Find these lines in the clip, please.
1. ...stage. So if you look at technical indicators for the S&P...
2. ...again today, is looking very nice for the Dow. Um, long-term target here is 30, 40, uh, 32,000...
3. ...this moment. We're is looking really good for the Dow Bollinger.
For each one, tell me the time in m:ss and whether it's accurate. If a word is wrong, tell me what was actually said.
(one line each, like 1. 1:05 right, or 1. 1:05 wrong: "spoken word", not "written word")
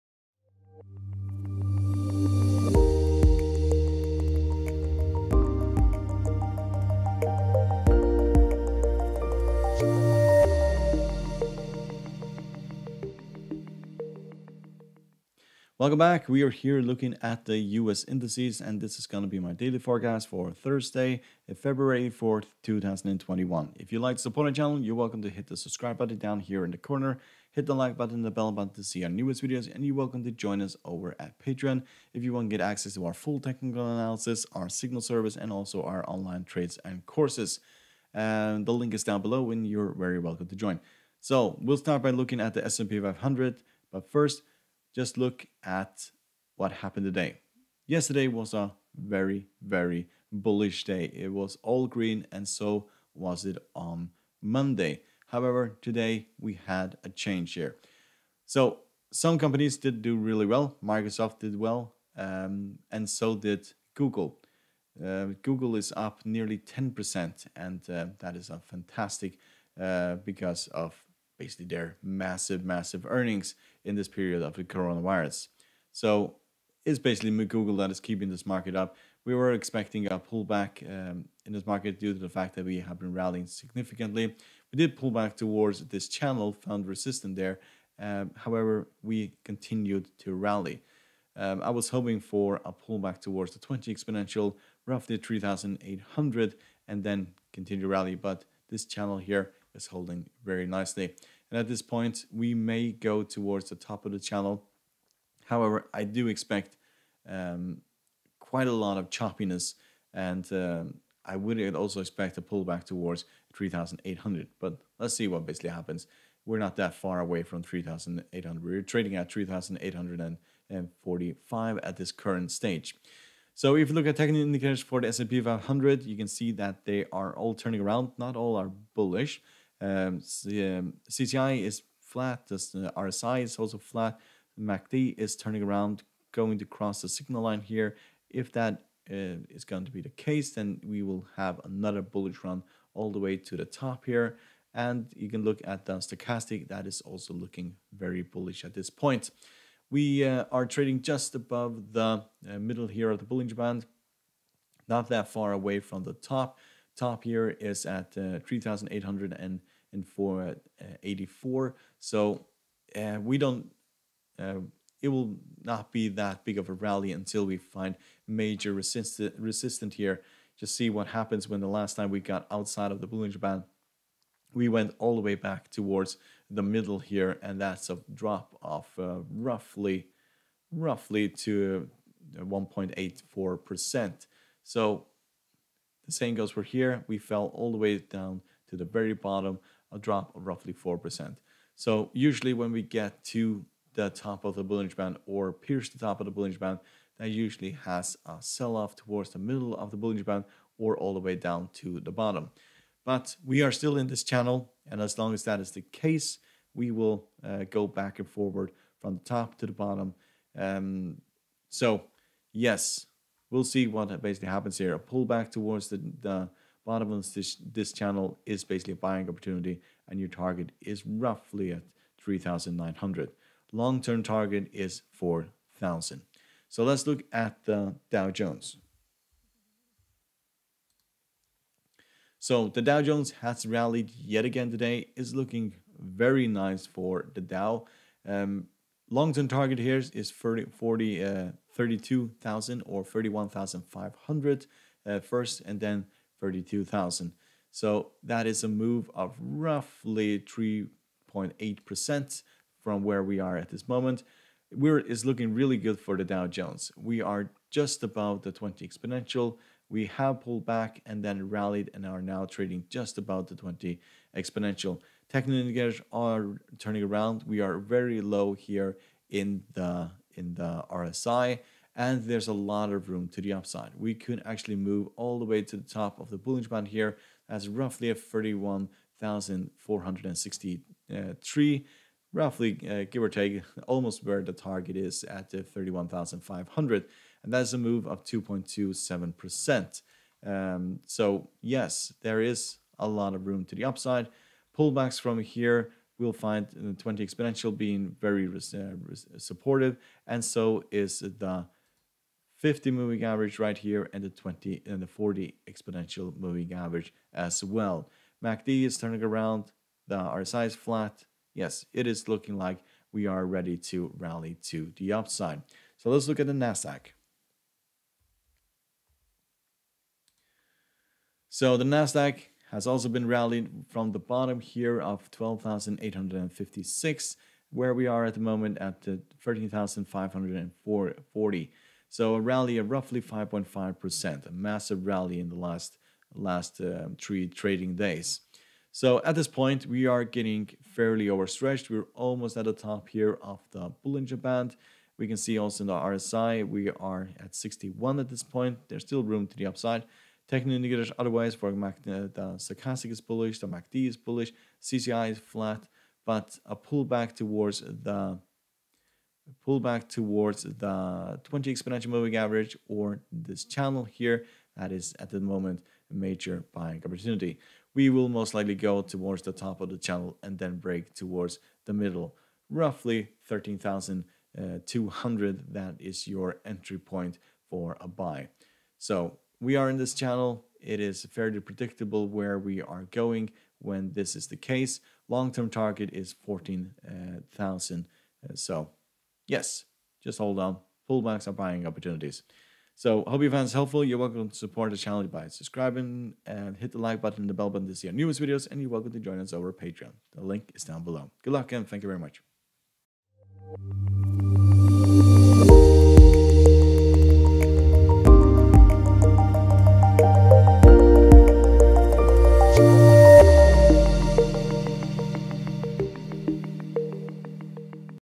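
1. 2:02 right
2. 3:54 right
3. 4:13 wrong: "Jones", not "Bollinger".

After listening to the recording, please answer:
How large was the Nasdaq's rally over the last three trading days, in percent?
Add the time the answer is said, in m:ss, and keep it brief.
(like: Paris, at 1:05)
5.5%, at 5:33.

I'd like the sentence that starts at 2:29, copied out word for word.
We uh, are trading just above the uh, middle here of the Bollinger Band, not that far away from the top.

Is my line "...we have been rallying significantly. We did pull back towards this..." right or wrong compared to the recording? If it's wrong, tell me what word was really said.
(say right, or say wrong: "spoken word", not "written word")
right.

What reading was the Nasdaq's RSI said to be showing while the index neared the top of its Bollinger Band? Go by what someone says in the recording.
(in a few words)
61.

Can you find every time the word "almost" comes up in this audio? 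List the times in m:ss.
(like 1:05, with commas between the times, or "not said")
4:43, 5:42.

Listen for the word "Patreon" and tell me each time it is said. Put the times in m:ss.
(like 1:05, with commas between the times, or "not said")
0:31, 6:39.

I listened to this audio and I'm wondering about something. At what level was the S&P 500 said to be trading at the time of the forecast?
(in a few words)
3,845.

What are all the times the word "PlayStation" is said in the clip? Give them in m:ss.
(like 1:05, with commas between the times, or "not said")
not said.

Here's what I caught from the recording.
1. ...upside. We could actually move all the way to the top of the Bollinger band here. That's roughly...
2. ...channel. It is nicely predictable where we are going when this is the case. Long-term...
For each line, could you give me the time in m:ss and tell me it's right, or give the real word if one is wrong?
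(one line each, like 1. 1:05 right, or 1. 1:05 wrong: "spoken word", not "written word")
1. 4:33 right
2. 6:20 wrong: "fairly", not "nicely".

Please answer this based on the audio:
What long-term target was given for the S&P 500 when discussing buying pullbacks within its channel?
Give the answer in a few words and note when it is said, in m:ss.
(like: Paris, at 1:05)
4,000, at 3:43.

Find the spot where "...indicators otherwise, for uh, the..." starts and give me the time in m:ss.
5:50.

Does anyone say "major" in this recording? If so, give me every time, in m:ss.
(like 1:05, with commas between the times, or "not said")
2:48, 6:06.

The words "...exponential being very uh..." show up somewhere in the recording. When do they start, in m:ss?
4:57.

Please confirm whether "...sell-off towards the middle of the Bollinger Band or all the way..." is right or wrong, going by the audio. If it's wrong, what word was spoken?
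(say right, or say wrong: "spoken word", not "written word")
right.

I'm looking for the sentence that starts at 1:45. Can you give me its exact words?
However, I do expect um, quite a lot of choppiness and um, I would also expect a pullback towards 3,800.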